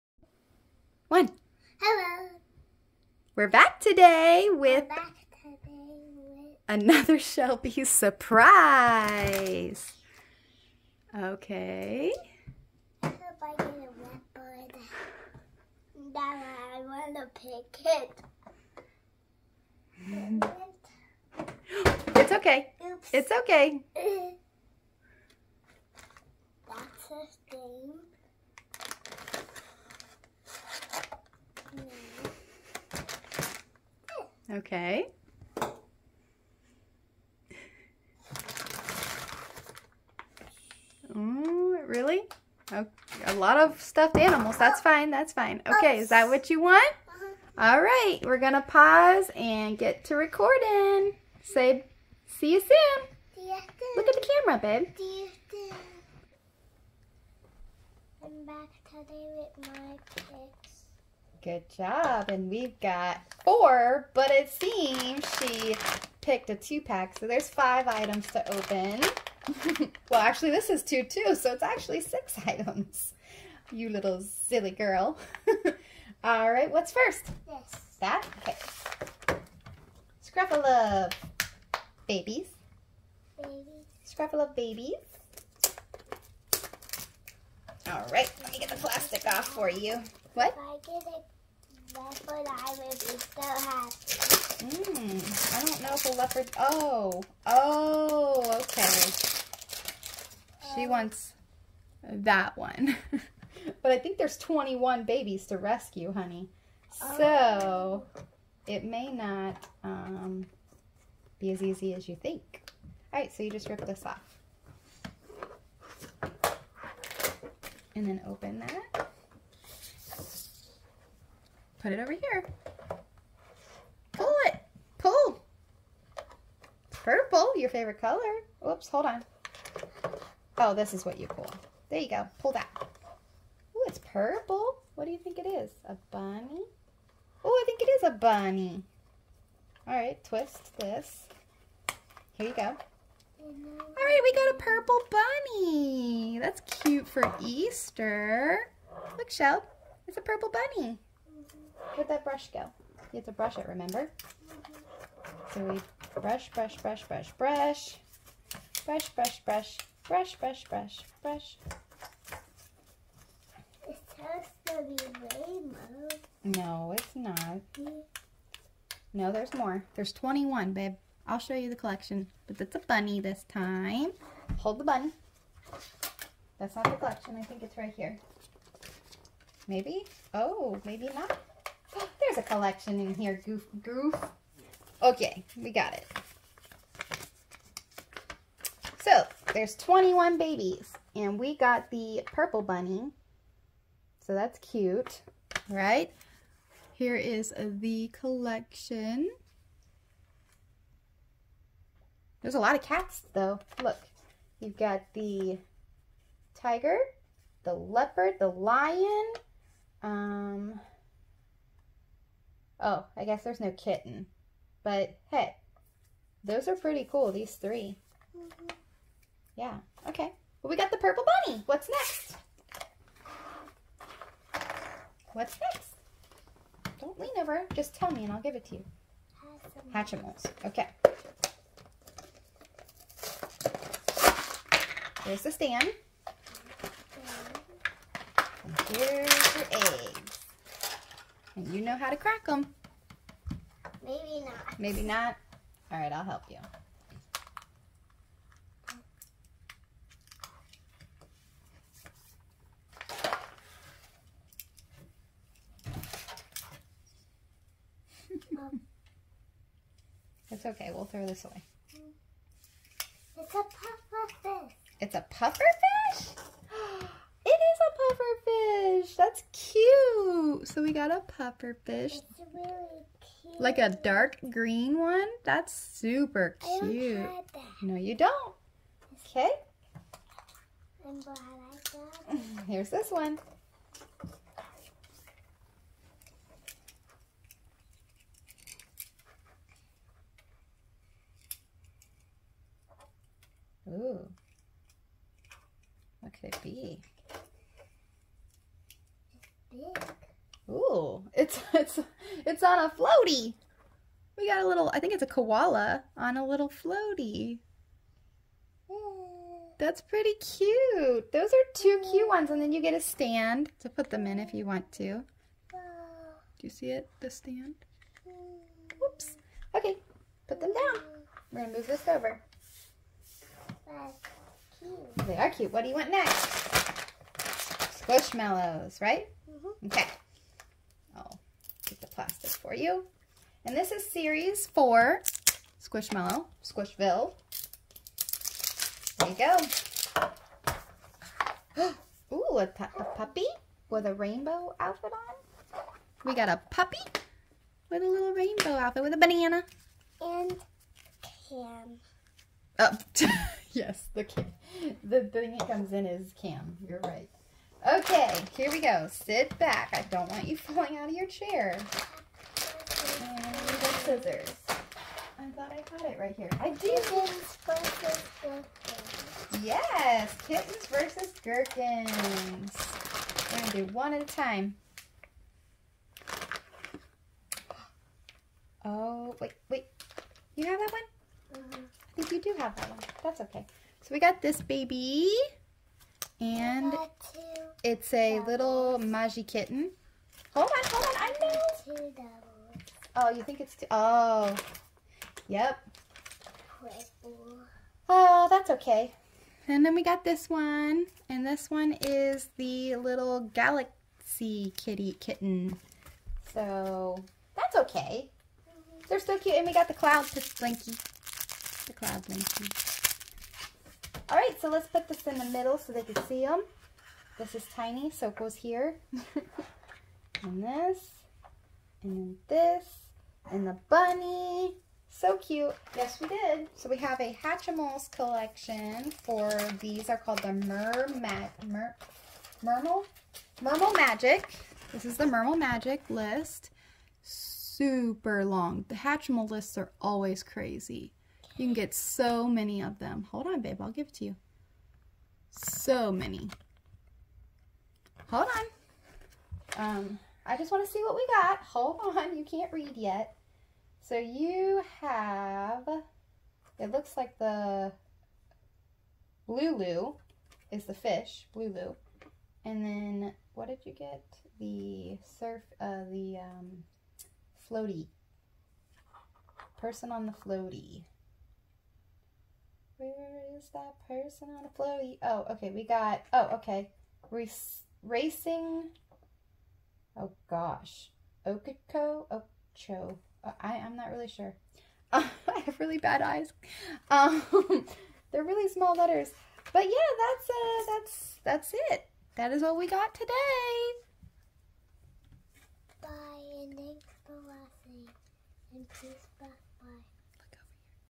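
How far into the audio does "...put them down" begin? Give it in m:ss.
5:20.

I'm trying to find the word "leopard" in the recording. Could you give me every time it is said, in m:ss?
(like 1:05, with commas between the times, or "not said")
0:14, 1:31, 1:36, 3:27.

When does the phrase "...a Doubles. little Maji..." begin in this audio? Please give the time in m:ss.
6:28.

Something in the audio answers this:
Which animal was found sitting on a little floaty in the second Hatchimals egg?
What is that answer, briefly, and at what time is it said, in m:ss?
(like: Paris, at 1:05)
koala, at 5:05.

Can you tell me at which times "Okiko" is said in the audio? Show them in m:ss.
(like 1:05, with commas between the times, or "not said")
8:01.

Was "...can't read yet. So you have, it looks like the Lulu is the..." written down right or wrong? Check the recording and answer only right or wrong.
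right.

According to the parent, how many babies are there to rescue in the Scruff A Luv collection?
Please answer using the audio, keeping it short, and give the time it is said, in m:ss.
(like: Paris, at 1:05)
21, at 1:44.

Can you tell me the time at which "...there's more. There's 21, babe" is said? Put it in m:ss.
2:49.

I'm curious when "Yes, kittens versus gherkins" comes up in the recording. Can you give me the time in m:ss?
6:09.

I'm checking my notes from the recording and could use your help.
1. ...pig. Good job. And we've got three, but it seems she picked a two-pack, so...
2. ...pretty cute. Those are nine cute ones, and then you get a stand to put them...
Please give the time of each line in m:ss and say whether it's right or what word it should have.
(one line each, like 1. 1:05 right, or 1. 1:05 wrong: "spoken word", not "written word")
1. 1:00 wrong: "four", not "three"
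2. 5:10 wrong: "two", not "nine".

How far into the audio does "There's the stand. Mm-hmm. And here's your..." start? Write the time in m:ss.
3:55.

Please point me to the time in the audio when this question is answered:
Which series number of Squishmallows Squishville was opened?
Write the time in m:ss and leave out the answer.
5:34.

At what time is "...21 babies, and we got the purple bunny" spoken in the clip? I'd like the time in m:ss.
3:09.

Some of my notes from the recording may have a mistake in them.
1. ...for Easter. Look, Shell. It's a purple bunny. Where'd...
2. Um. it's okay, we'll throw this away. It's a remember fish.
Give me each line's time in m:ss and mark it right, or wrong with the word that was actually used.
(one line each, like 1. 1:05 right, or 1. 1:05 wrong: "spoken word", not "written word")
1. 2:27 right
2. 4:18 wrong: "puffer", not "remember".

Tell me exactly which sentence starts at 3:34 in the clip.
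But hey, those are pretty cool, these 3 mm -hmm.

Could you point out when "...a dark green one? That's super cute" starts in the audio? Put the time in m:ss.
4:33.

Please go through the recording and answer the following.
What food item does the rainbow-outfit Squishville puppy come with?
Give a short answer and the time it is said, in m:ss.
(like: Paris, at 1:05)
banana, at 5:49.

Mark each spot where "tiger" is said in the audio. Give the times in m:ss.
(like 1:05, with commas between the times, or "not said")
3:26.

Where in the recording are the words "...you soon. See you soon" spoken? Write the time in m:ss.
0:52.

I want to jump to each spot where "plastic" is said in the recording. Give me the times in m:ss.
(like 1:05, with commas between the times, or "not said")
1:28, 5:32.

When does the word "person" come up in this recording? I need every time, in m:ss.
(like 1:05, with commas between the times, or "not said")
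7:49, 7:54.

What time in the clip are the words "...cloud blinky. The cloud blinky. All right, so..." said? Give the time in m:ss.
6:49.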